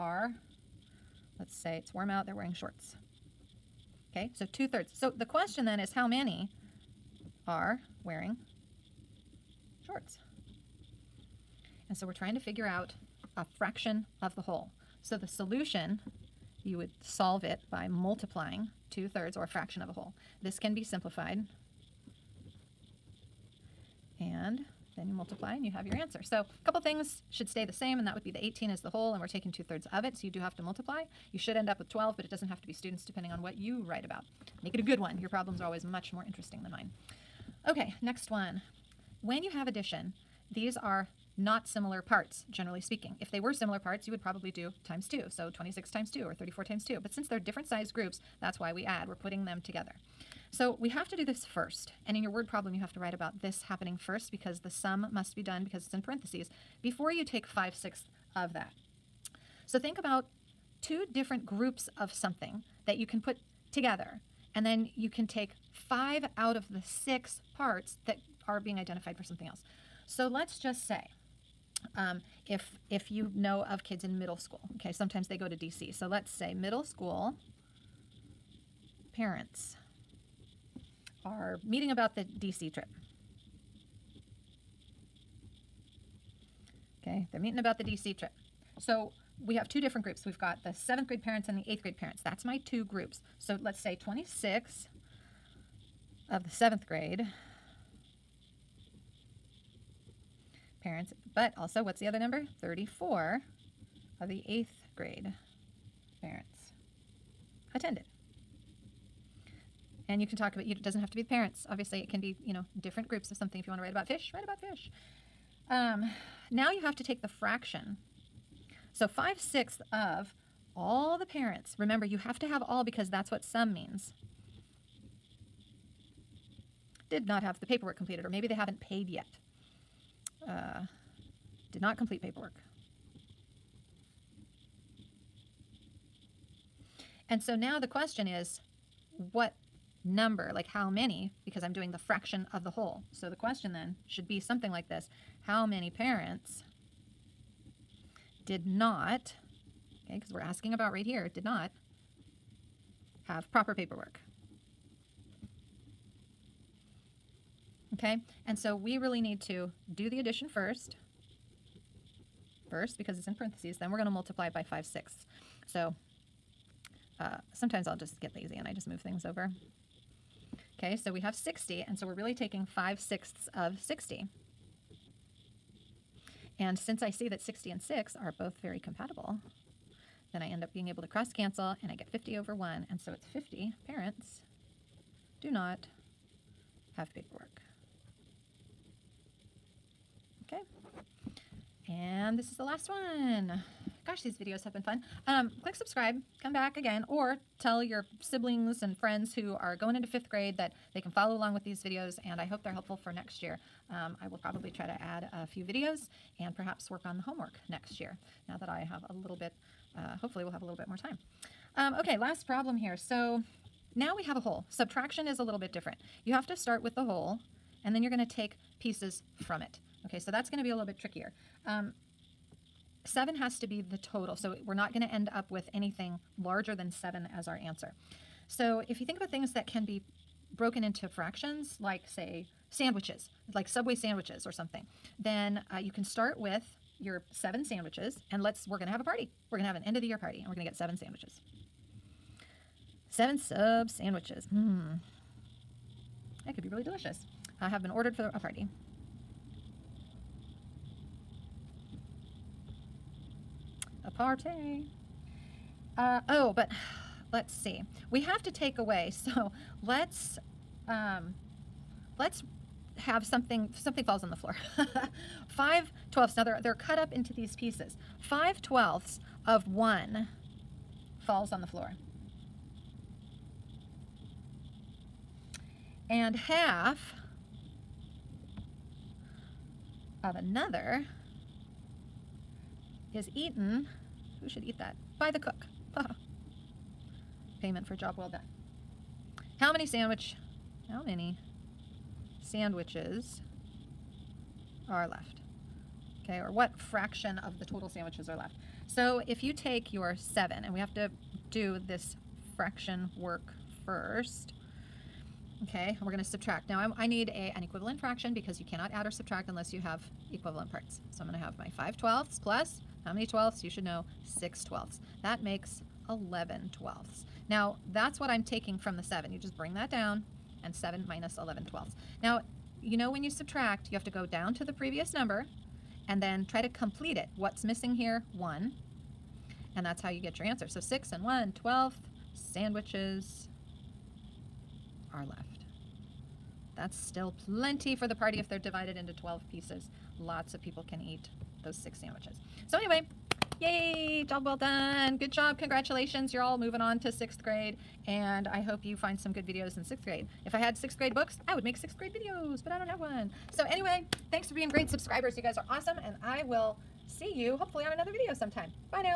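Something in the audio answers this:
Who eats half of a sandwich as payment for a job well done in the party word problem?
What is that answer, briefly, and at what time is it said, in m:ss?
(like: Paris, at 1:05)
The cook, at 4:45.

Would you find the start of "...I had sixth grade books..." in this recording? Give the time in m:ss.
5:50.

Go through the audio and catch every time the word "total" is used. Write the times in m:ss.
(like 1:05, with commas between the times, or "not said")
3:43, 4:57.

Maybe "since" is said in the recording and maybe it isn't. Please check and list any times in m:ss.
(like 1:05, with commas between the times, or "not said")
0:47, 2:56.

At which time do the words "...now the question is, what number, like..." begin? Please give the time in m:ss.
2:17.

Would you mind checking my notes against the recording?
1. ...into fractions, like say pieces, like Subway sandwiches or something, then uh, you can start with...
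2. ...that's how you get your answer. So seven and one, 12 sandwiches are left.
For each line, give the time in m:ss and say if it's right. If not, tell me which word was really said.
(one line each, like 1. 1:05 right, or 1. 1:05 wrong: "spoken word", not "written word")
1. 3:50 wrong: "sandwiches", not "pieces"
2. 5:29 wrong: "six", not "seven".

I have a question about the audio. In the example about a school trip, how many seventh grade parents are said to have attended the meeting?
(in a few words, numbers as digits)
26.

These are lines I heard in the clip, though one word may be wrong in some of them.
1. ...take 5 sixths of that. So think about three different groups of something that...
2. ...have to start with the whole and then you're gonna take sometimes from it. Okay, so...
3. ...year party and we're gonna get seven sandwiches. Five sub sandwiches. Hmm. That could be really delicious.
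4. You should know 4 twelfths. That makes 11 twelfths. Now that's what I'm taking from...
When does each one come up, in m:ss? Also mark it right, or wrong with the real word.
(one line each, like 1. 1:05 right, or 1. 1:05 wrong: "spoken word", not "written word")
1. 0:57 wrong: "two", not "three"
2. 3:36 wrong: "pieces", not "sometimes"
3. 4:00 wrong: "Seven", not "Five"
4. 5:13 wrong: "6", not "4".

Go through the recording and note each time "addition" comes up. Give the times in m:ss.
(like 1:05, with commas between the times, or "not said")
0:39, 2:40.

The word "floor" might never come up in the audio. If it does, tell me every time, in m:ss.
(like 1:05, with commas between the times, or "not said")
4:24, 4:31.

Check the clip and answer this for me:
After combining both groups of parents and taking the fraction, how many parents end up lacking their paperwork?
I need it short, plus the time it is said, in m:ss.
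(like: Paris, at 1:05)
50, at 3:03.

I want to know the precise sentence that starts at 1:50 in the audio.
And you can talk about, it doesn't have to be the parents.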